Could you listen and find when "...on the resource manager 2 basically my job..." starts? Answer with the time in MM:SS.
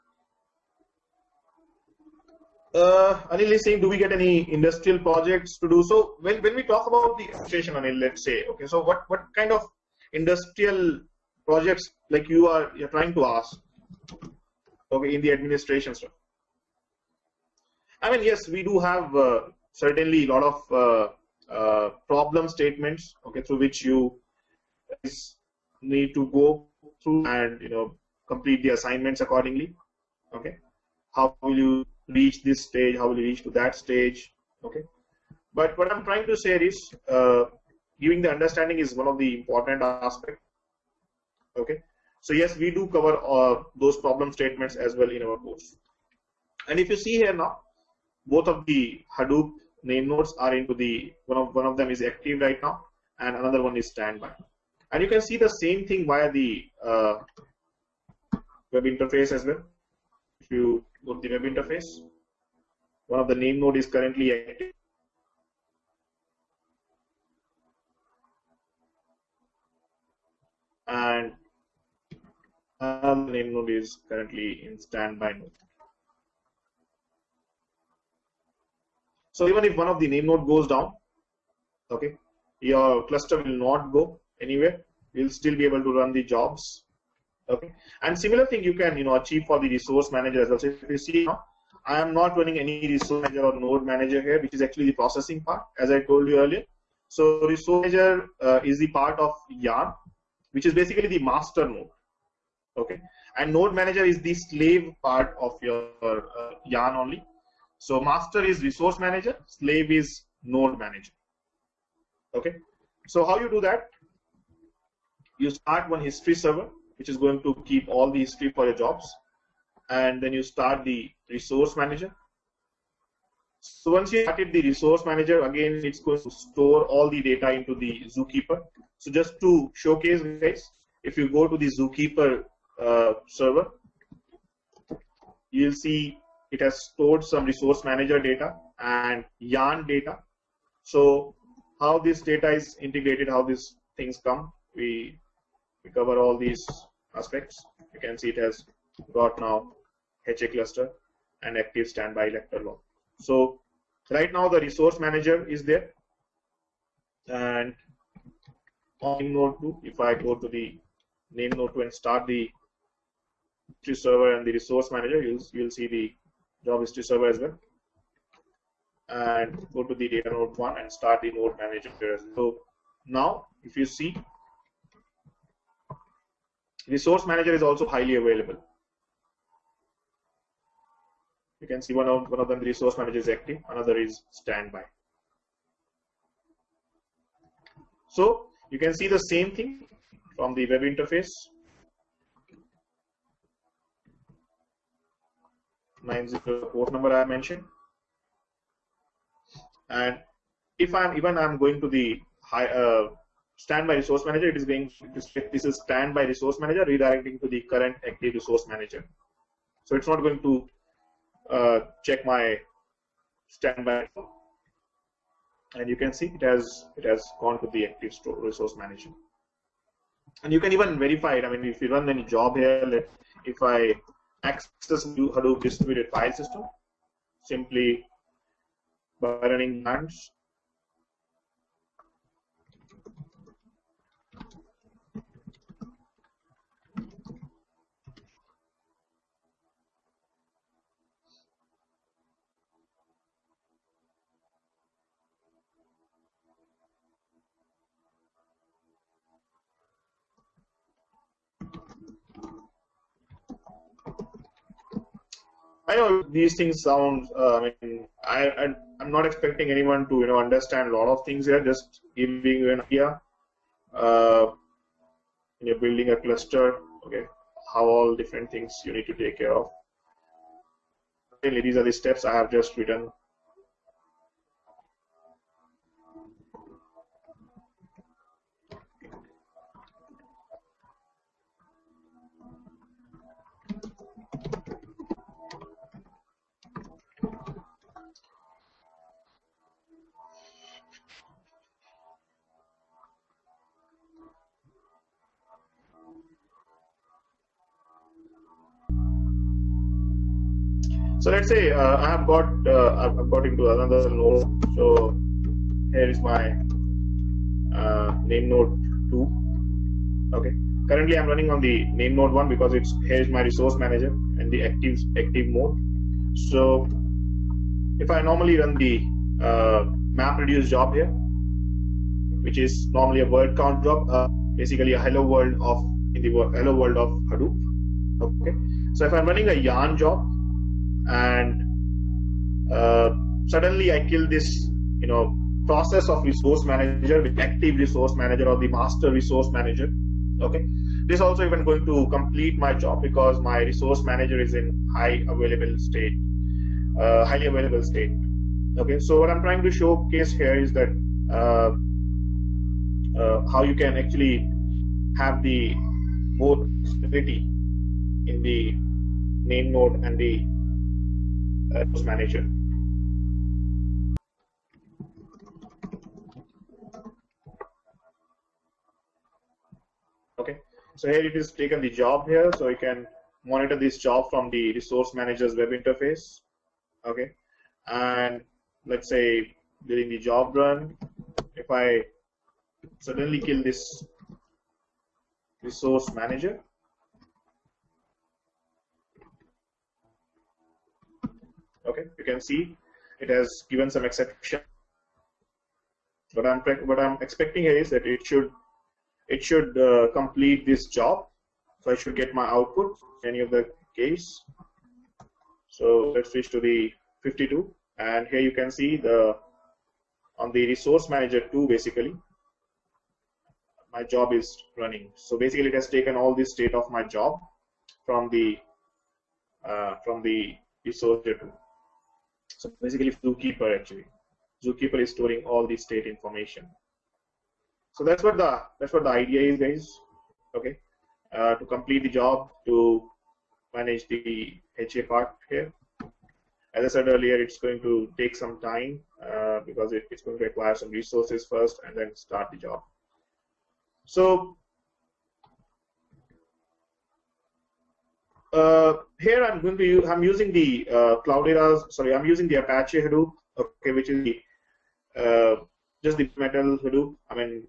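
06:50.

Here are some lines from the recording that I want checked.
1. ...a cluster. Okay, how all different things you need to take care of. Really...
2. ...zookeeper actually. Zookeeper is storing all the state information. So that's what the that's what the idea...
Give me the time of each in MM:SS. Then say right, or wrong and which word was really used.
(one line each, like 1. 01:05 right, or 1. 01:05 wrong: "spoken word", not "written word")
1. 04:26 right
2. 07:03 right.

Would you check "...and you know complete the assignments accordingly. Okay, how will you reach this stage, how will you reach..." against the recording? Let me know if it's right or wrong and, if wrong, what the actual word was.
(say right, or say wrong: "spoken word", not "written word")
right.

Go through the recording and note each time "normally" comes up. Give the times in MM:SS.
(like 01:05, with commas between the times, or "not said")
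05:18, 05:22.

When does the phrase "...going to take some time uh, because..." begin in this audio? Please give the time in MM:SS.
07:17.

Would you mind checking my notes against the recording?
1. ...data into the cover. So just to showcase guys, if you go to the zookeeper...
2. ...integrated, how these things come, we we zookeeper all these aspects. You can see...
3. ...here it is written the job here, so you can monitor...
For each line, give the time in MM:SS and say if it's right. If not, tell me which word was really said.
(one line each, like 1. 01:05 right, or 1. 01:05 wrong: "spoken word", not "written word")
1. 02:07 wrong: "zookeeper", not "cover"
2. 02:22 wrong: "cover", not "zookeeper"
3. 06:11 wrong: "taken", not "written".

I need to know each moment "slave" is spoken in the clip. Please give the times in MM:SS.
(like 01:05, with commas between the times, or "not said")
01:44, 01:49.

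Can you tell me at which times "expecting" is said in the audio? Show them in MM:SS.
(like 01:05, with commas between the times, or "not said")
04:19, 06:37.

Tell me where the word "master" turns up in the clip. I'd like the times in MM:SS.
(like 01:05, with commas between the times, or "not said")
01:41, 01:48, 05:38.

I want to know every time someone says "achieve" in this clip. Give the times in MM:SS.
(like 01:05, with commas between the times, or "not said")
01:29.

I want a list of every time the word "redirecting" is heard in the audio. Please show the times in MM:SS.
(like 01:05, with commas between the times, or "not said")
03:26.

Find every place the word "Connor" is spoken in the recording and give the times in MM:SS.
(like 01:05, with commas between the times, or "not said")
not said.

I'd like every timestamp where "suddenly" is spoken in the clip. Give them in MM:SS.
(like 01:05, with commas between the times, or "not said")
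05:33, 06:22.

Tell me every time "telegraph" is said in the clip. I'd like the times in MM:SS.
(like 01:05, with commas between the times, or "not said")
not said.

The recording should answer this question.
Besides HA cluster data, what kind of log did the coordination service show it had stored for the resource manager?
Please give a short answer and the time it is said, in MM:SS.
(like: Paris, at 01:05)
Active standby elector log, at 02:31.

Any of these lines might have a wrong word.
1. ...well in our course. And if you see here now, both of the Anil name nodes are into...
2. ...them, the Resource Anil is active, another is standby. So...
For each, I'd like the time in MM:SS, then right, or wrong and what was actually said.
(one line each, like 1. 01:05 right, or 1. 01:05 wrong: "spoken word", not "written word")
1. 00:44 wrong: "Hadoop", not "Anil"
2. 03:02 wrong: "Manager", not "Anil".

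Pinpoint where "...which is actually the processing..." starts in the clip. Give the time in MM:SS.
01:34.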